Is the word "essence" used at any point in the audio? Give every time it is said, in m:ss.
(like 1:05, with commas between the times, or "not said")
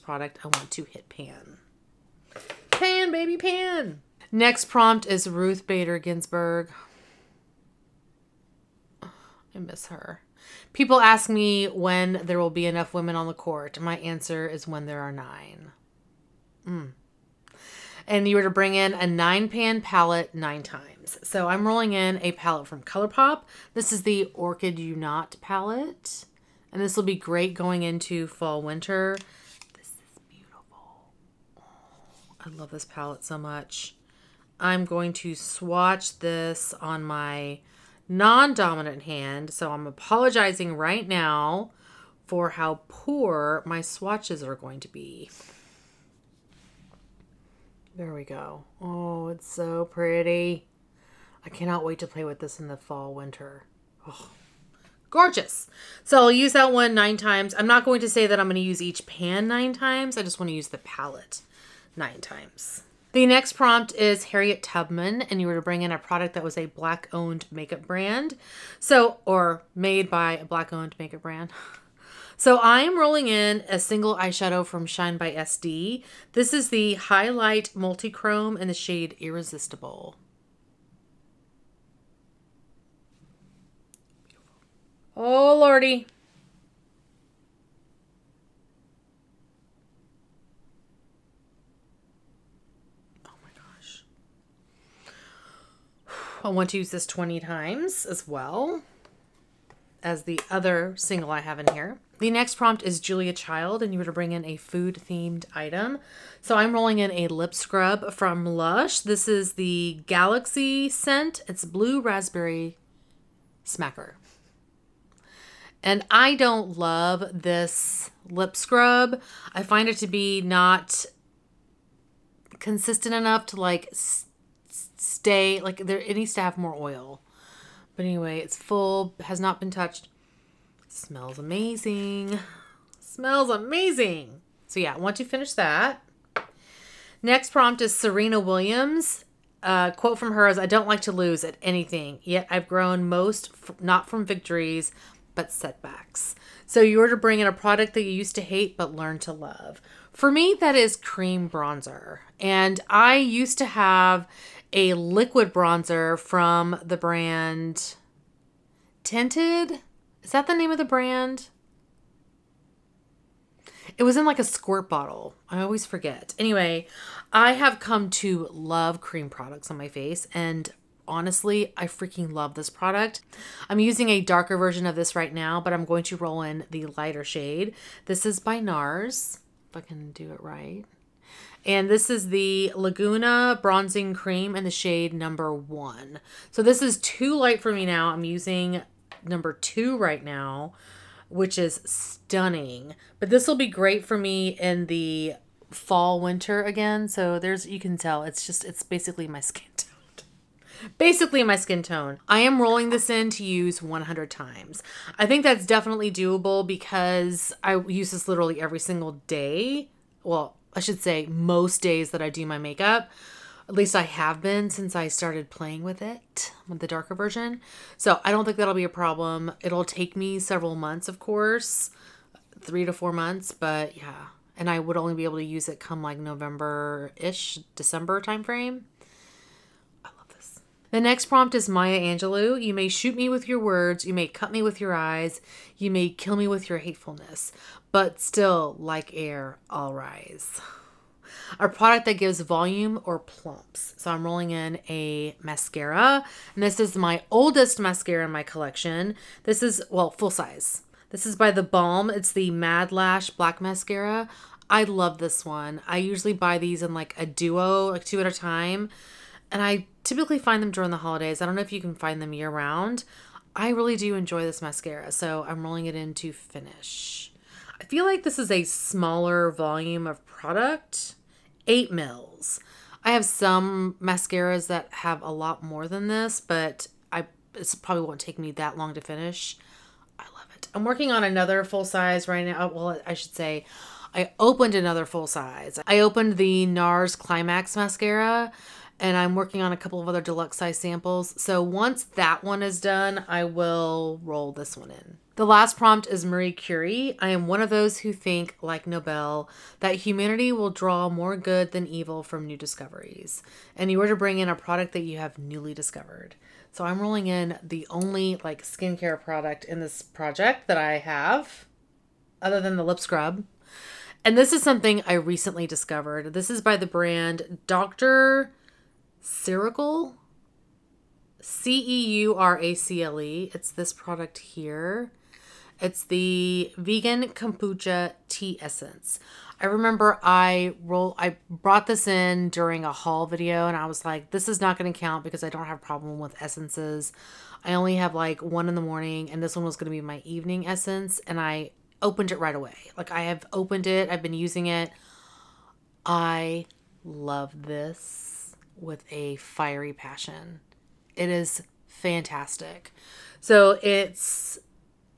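5:28, 5:36, 5:40.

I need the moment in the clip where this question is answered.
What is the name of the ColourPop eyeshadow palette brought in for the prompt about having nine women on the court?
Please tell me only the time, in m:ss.
0:24.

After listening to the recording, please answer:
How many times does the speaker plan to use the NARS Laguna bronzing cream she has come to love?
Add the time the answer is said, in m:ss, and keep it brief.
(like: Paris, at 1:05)
100, at 3:23.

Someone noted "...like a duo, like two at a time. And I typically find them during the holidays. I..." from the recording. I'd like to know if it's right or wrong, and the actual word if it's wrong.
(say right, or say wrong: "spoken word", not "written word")
right.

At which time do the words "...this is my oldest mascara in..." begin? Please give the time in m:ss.
4:06.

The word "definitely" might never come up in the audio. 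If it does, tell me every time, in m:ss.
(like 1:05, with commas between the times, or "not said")
3:25.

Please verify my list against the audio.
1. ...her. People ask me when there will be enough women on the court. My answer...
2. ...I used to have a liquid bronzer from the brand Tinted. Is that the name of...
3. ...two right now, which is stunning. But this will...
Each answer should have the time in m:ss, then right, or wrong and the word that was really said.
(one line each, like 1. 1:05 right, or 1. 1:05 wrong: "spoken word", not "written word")
1. 0:09 right
2. 2:32 right
3. 3:09 right.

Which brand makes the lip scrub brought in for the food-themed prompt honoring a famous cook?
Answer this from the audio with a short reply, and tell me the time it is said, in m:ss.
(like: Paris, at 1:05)
Lush, at 1:48.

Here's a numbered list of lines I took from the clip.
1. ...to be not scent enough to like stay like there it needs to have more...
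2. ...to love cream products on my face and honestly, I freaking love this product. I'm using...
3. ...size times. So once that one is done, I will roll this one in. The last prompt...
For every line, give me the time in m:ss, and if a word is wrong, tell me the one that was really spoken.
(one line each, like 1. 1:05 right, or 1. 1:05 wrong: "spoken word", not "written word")
1. 1:59 wrong: "consistent", not "scent"
2. 2:48 right
3. 4:50 wrong: "samples", not "times".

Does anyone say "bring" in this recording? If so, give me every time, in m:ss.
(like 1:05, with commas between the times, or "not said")
0:18, 1:05, 1:44, 2:27, 5:04.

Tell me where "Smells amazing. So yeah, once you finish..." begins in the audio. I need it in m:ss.
2:12.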